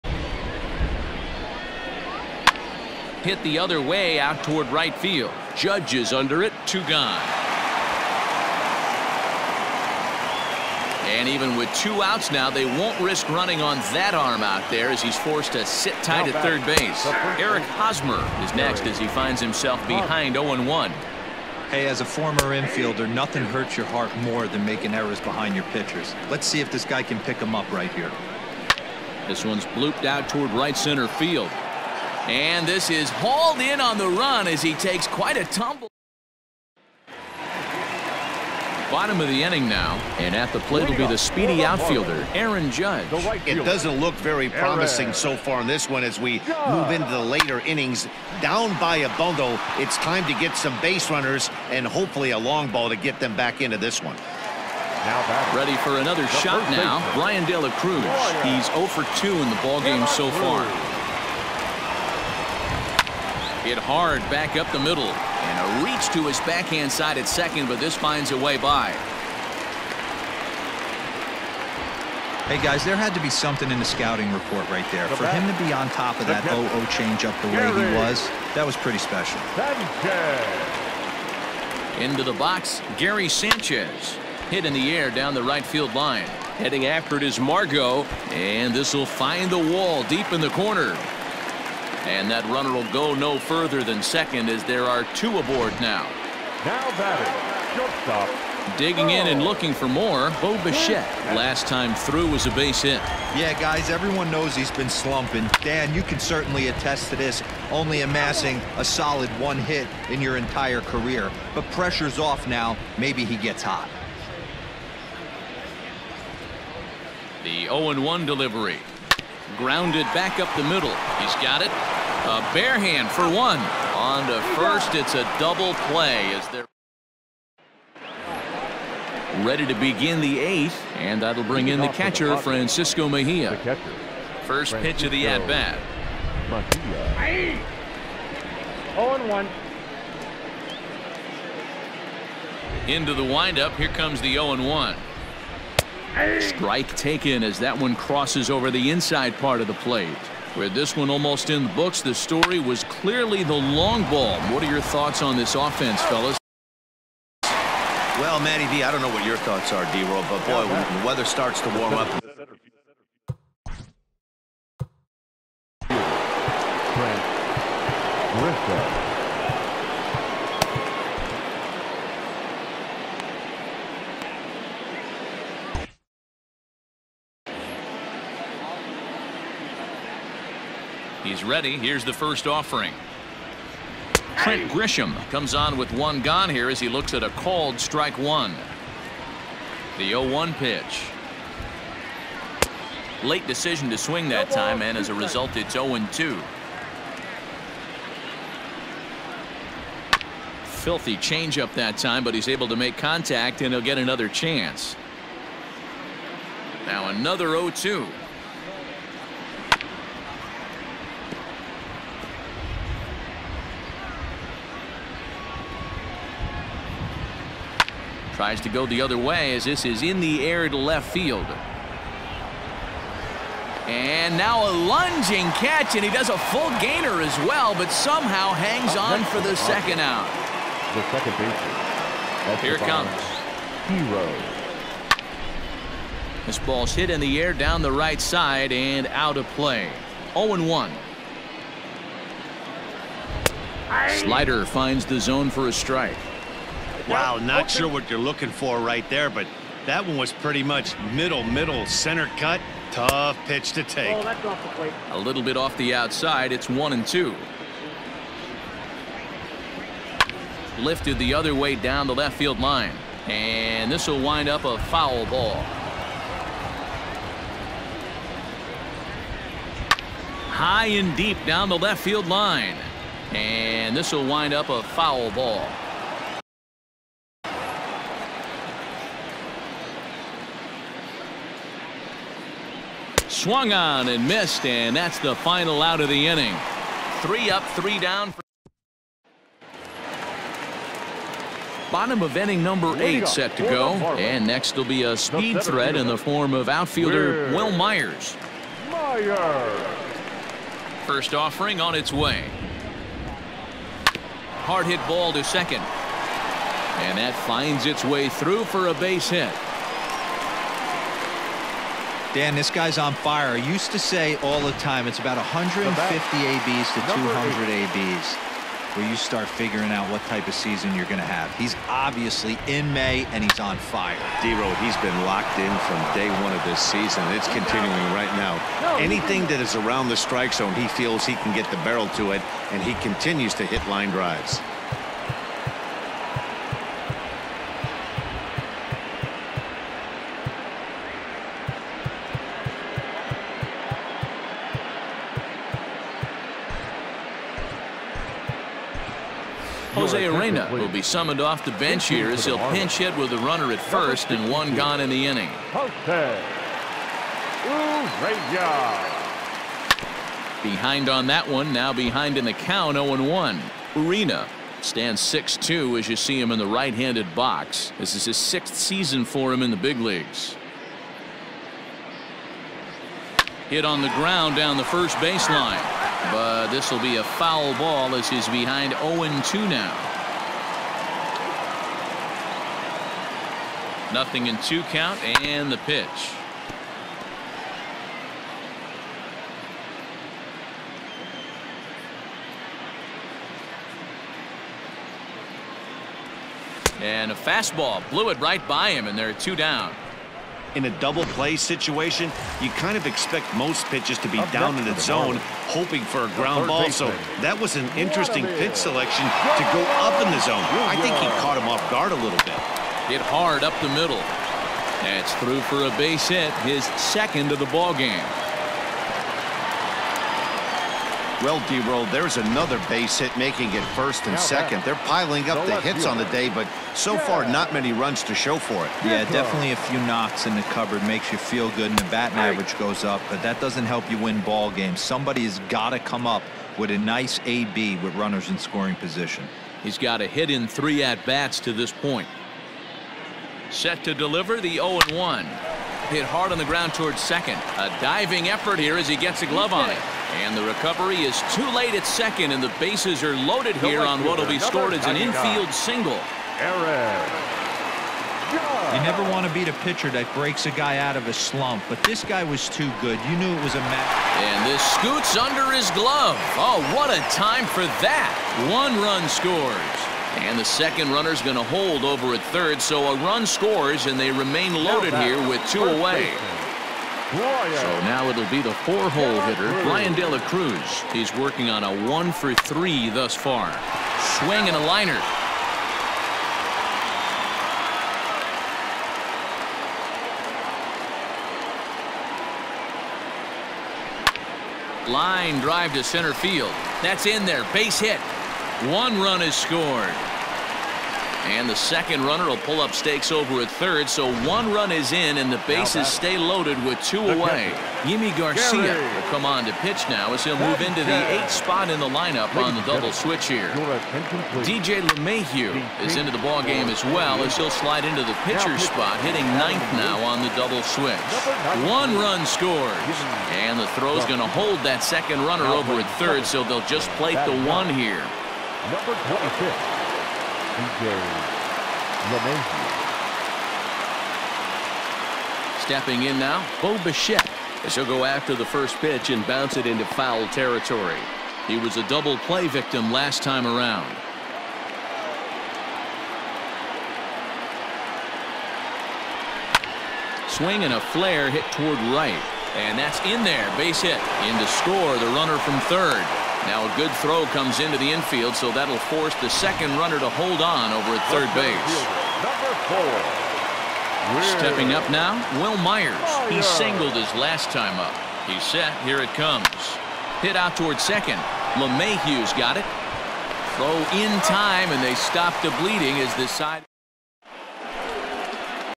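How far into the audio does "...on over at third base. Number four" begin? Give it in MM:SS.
09:20.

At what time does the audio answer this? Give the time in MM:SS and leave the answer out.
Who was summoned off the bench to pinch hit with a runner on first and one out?
05:49.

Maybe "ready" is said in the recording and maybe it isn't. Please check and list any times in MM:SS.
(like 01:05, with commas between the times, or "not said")
00:55, 02:09, 03:01.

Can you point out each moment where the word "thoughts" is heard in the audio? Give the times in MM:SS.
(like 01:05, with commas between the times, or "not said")
02:34, 02:39.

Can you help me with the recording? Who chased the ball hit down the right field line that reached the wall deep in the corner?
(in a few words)
Margot.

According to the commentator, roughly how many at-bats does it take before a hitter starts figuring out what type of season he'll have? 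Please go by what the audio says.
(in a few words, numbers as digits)
150.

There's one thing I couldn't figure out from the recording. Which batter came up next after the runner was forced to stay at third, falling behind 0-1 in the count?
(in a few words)
Eric Hosmer.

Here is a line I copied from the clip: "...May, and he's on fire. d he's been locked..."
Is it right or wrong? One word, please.
right.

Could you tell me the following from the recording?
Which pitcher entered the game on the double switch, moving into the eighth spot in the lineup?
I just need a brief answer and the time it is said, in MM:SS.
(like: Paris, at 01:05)
Yimi Garcia, at 08:28.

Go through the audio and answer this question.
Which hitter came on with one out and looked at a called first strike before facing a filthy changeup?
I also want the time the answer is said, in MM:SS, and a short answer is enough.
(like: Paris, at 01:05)
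Trent Grisham, at 03:04.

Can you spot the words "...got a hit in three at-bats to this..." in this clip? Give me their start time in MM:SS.
07:19.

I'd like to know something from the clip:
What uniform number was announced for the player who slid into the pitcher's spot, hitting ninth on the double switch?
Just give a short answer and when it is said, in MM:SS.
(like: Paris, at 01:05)
25, at 08:48.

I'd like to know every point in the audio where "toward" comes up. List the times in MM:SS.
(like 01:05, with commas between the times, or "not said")
00:04, 00:30, 07:26, 09:11, 09:30.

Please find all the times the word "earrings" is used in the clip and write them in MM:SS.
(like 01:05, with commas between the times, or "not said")
not said.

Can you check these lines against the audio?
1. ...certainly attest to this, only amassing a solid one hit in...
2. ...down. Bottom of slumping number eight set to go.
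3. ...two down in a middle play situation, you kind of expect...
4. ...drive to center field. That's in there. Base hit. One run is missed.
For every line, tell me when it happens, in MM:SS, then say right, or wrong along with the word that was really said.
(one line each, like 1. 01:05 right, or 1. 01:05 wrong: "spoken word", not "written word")
1. 01:46 right
2. 04:47 wrong: "inning", not "slumping"
3. 06:39 wrong: "double", not "middle"
4. 08:15 wrong: "scored", not "missed".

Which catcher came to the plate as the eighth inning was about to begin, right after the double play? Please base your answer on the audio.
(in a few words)
Francisco Mejia.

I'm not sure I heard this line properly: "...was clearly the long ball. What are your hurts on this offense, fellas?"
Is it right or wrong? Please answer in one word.
wrong.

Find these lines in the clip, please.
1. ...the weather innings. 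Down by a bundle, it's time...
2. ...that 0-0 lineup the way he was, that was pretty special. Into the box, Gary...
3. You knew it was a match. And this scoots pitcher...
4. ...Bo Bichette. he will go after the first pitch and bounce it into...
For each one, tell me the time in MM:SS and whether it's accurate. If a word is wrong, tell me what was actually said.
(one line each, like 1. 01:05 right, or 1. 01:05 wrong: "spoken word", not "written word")
1. 00:47 wrong: "later", not "weather"
2. 01:16 wrong: "changeup", not "lineup"
3. 07:43 wrong: "under", not "pitcher"
4. 08:56 right.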